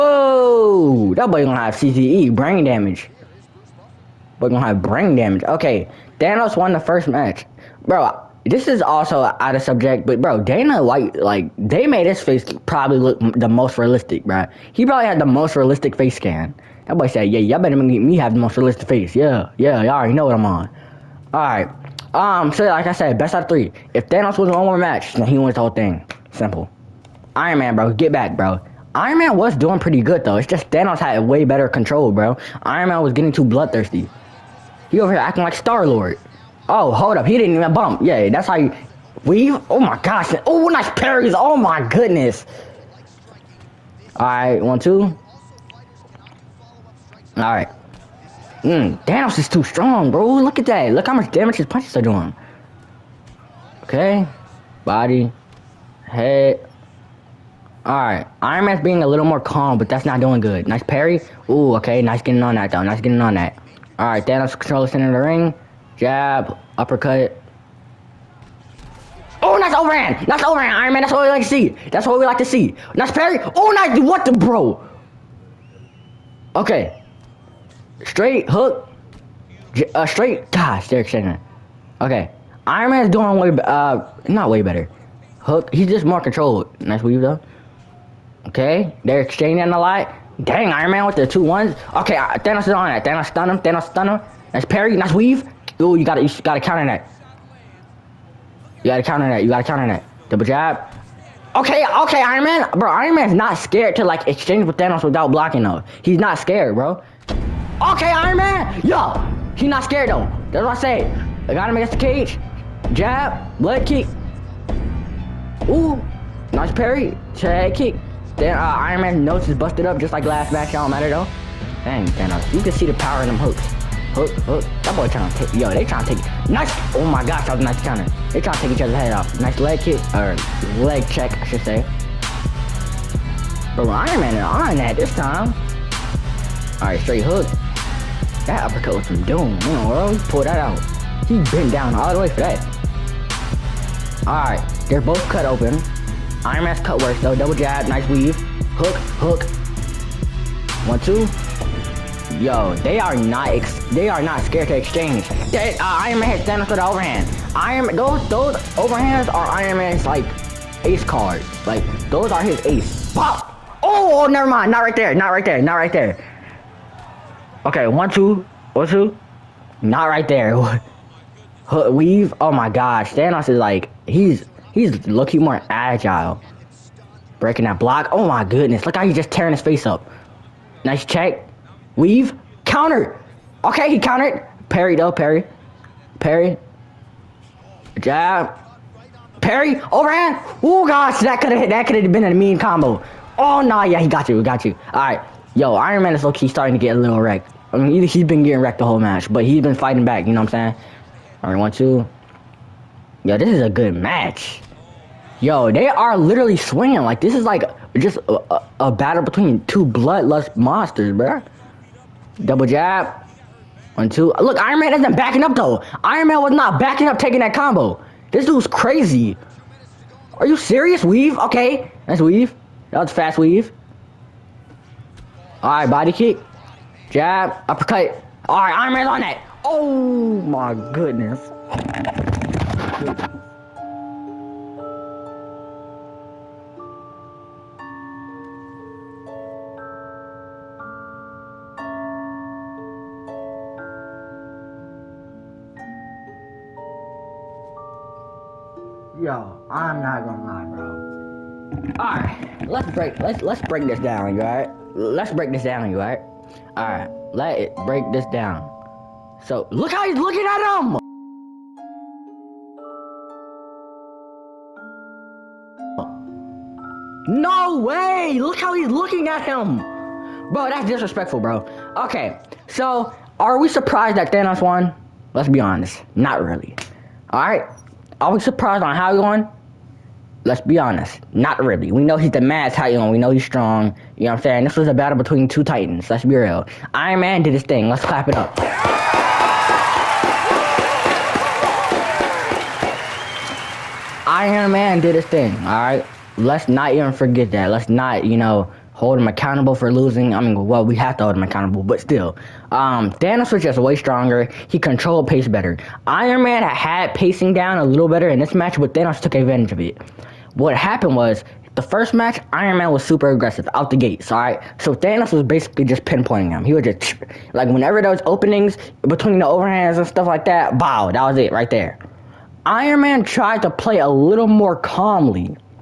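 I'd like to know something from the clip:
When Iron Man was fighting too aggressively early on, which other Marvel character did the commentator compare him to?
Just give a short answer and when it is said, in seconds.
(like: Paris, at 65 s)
Star Lord, at 35 s.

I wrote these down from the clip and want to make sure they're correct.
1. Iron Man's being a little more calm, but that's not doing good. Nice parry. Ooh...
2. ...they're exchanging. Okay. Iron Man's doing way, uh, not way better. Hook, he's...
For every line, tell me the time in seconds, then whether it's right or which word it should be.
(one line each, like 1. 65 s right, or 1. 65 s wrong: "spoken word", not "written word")
1. 58 s right
2. 80 s right.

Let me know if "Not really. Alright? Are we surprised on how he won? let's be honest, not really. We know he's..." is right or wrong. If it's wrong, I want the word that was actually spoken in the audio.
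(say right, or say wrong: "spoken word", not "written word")
right.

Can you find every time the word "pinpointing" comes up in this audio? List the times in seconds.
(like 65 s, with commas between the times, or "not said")
316 s.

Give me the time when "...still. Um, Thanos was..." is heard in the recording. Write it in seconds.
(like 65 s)
302 s.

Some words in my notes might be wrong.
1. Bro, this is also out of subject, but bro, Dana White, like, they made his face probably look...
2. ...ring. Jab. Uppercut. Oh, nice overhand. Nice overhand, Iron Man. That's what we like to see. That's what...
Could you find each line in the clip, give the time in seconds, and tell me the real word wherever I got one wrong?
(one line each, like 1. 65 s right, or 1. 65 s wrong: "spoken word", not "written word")
1. 7 s right
2. 65 s right.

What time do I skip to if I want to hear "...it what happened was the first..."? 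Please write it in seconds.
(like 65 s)
309 s.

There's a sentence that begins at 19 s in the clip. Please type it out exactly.
Yeah, yeah, y'all already know what I'm on.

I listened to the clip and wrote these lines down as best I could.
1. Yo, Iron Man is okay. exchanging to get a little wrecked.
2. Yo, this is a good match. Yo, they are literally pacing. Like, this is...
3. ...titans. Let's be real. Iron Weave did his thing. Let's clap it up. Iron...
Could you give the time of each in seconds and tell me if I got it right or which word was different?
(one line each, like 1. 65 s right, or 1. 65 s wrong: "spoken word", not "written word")
1. 195 s wrong: "starting", not "exchanging"
2. 203 s wrong: "swinging", not "pacing"
3. 285 s wrong: "Man", not "Weave".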